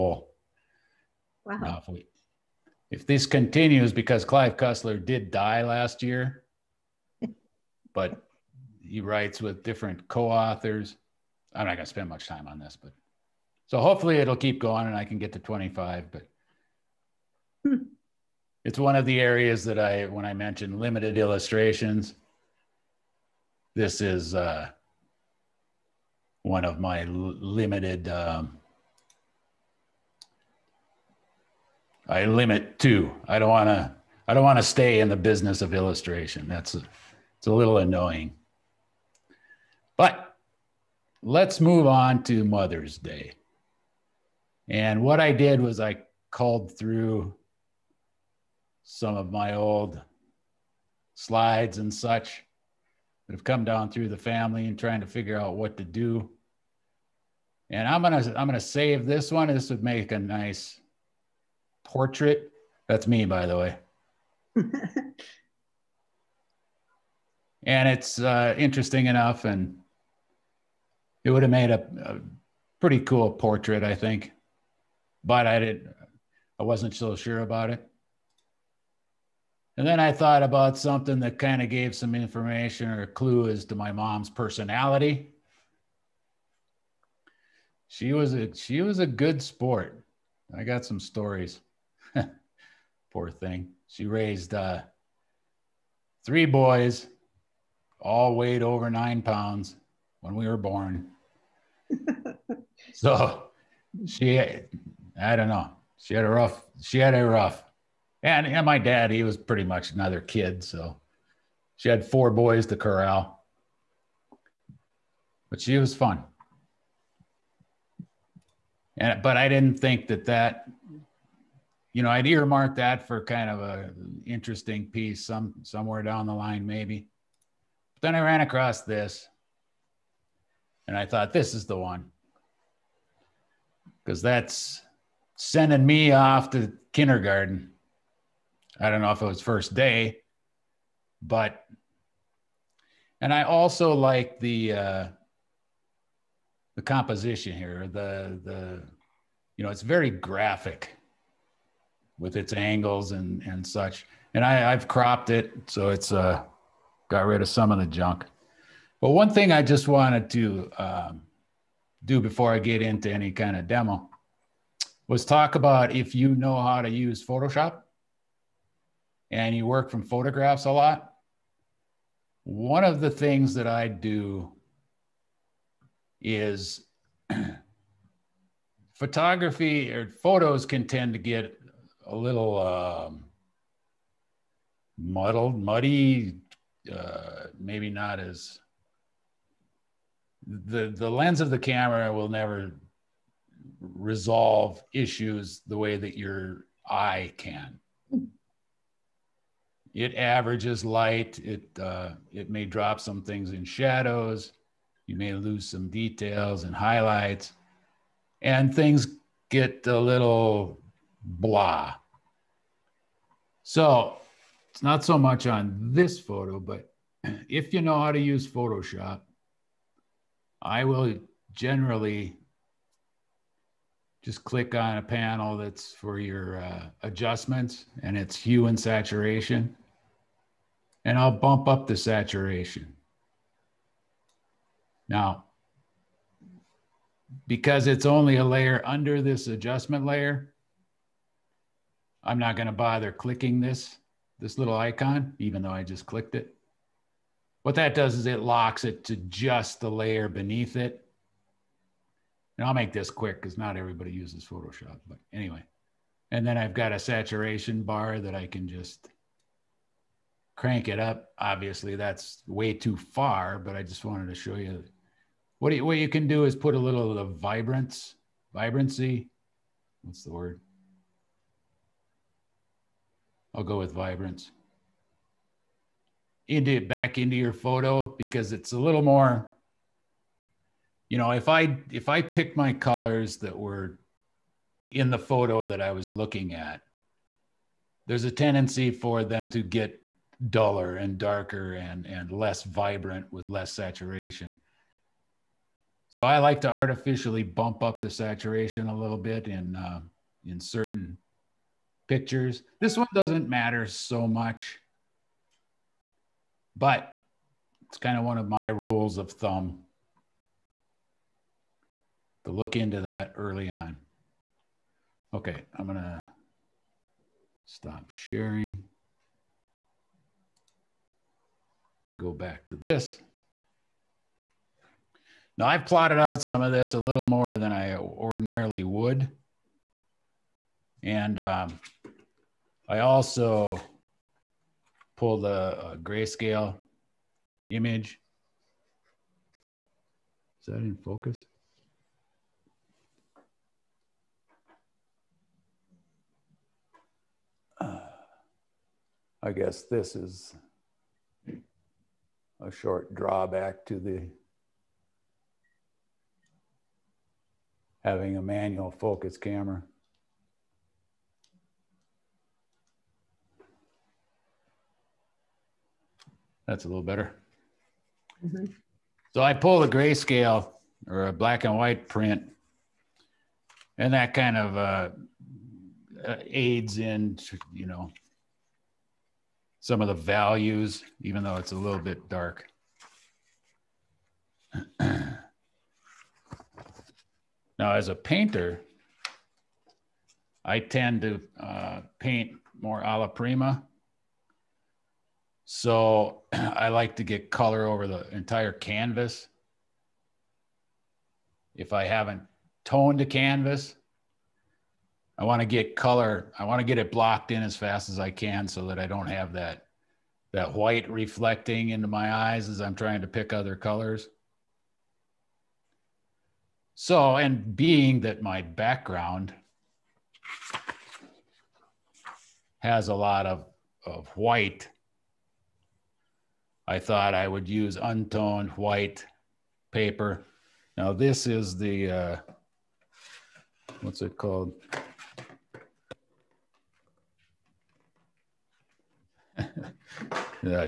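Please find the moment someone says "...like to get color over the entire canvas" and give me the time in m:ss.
6:36.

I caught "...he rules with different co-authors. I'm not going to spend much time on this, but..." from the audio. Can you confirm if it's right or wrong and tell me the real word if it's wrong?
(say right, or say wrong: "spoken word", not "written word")
wrong: "writes", not "rules".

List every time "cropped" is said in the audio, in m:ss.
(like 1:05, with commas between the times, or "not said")
2:34.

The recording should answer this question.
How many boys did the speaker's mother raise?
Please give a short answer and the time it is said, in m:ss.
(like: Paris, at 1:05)
3, at 1:36.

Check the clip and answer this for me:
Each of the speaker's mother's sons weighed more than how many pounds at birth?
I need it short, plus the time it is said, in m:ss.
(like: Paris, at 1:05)
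9, at 1:38.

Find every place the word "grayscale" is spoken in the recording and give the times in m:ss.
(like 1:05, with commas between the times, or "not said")
5:35, 6:09.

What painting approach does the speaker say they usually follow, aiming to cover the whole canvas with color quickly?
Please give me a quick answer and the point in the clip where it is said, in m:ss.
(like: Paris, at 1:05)
A la prima, at 6:33.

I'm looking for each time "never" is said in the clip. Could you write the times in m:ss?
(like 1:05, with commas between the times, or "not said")
3:12.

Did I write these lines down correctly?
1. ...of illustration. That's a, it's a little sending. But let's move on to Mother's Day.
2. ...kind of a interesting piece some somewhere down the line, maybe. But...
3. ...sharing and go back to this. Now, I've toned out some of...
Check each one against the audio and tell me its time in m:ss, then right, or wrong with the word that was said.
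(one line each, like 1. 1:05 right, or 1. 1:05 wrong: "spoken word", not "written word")
1. 0:35 wrong: "annoying", not "sending"
2. 2:03 right
3. 5:18 wrong: "plotted", not "toned".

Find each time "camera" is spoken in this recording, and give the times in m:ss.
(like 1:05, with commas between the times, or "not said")
3:11, 5:59.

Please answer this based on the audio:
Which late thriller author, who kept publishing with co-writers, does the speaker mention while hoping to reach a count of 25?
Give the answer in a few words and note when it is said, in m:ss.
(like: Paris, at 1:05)
Clive Cussler, at 0:04.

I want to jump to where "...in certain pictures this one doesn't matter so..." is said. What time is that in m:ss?
5:00.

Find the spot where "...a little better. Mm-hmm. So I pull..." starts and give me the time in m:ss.
6:06.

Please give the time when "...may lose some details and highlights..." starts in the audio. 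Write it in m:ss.
3:25.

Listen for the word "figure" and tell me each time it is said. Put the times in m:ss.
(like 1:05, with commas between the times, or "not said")
0:55.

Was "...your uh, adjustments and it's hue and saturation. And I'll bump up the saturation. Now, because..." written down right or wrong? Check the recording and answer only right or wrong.
right.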